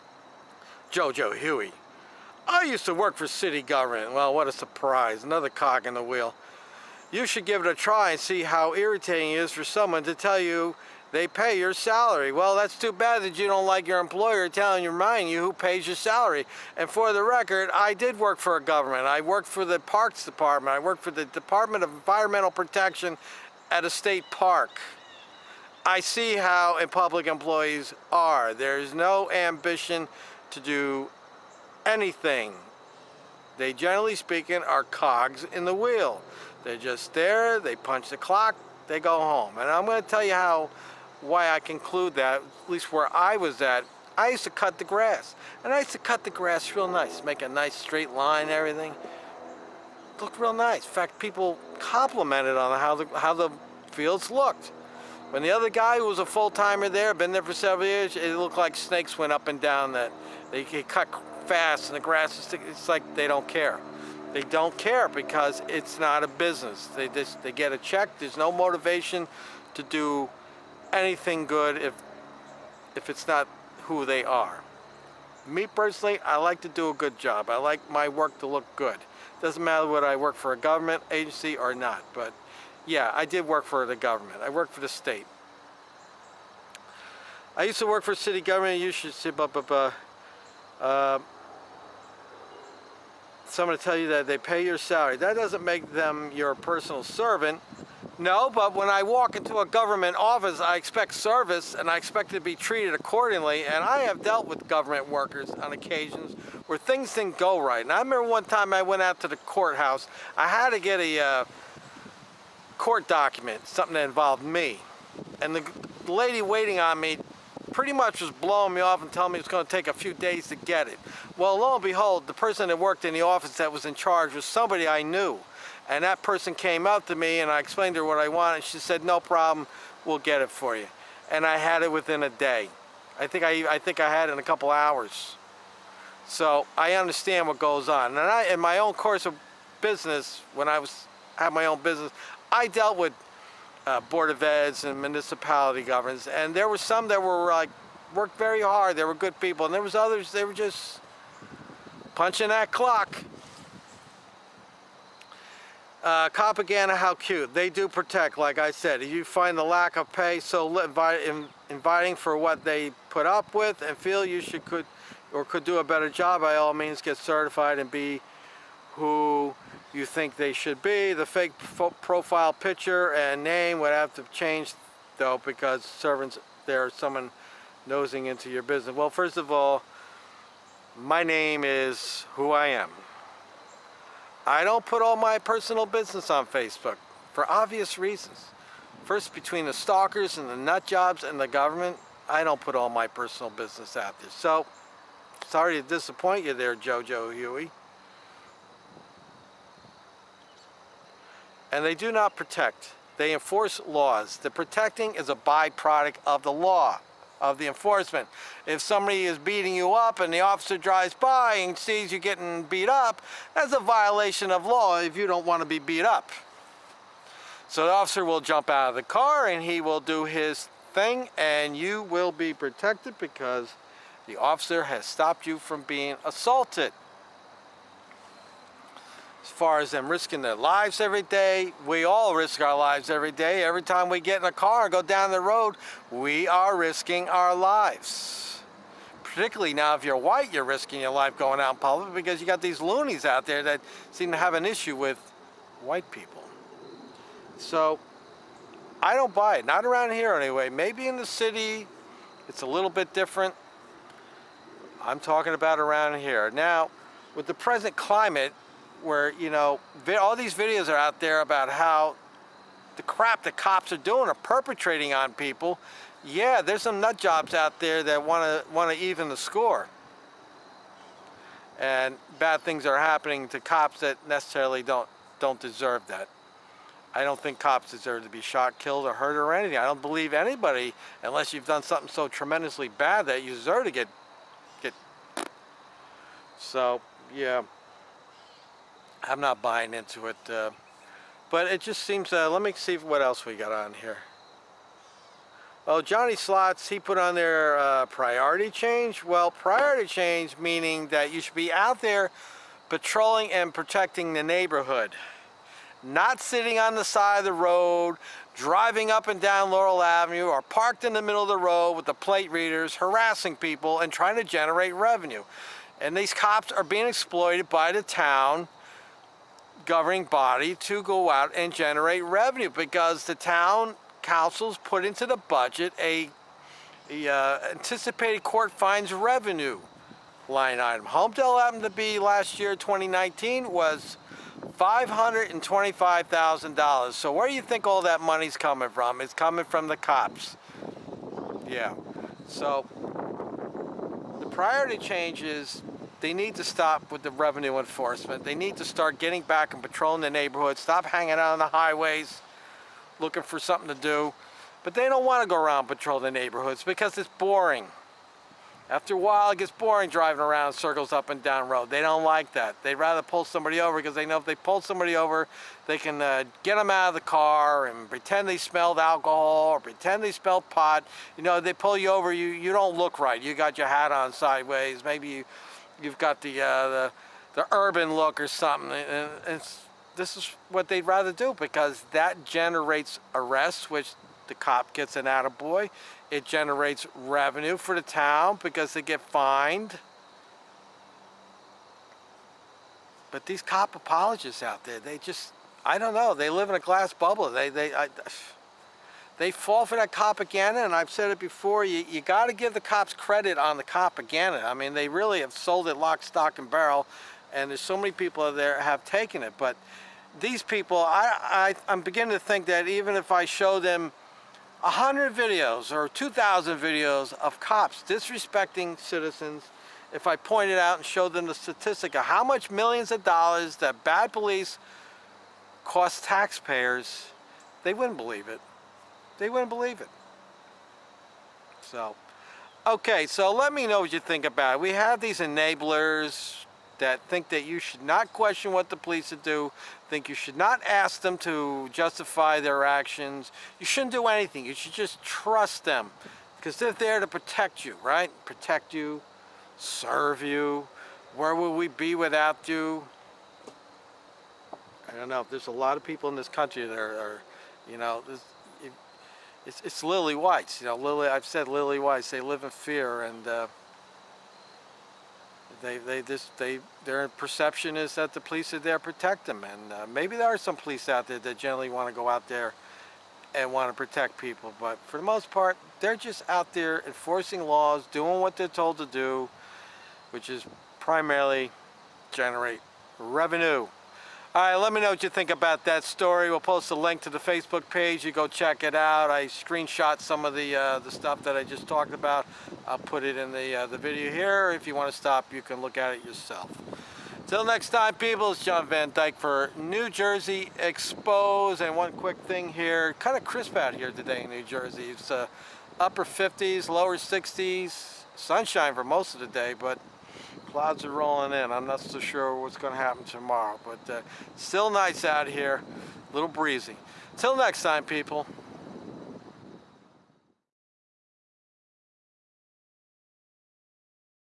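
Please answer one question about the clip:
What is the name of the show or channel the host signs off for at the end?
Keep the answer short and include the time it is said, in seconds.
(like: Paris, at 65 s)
New Jersey Expose, at 499 s.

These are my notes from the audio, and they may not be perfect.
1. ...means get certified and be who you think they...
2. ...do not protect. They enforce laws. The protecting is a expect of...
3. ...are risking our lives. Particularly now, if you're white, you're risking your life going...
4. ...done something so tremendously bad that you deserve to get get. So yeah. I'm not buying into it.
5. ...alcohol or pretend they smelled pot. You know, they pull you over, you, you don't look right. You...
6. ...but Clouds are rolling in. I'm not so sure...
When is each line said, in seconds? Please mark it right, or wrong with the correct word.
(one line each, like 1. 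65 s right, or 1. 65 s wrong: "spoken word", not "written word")
1. 166 s right
2. 201 s wrong: "byproduct", not "expect"
3. 236 s right
4. 281 s right
5. 368 s right
6. 509 s right.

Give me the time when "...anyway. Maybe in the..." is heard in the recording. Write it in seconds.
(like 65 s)
250 s.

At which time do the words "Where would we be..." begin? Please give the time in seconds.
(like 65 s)
451 s.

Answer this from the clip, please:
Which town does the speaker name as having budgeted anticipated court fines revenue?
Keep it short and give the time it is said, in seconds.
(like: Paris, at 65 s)
Holmdel, at 331 s.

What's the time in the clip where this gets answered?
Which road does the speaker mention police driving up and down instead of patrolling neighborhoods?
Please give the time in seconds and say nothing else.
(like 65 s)
309 s.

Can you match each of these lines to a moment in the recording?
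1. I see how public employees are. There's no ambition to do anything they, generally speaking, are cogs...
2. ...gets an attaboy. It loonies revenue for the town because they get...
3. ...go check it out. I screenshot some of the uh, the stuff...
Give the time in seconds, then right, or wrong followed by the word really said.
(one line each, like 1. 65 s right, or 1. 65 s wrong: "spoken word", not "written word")
1. 25 s right
2. 384 s wrong: "generates", not "loonies"
3. 488 s right.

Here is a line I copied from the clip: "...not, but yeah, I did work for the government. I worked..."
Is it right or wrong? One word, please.
right.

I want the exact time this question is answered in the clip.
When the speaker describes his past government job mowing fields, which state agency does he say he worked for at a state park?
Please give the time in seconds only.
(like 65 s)
21 s.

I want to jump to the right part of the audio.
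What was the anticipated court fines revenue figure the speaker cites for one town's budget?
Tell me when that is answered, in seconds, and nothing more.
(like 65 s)
334 s.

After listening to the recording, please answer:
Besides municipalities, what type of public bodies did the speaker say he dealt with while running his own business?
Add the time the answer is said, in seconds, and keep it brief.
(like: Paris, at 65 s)
Board of Eds, at 143 s.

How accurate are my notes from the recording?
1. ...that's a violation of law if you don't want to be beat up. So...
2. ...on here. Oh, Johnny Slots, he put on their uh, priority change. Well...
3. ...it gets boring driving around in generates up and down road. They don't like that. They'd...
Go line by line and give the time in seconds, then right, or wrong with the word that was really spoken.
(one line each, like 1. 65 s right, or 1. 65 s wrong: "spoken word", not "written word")
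1. 213 s right
2. 293 s right
3. 359 s wrong: "circles", not "generates".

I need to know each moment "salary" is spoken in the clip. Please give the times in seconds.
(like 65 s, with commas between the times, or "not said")
11 s, 15 s, 94 s.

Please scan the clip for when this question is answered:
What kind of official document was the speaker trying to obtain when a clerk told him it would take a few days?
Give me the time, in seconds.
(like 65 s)
112 s.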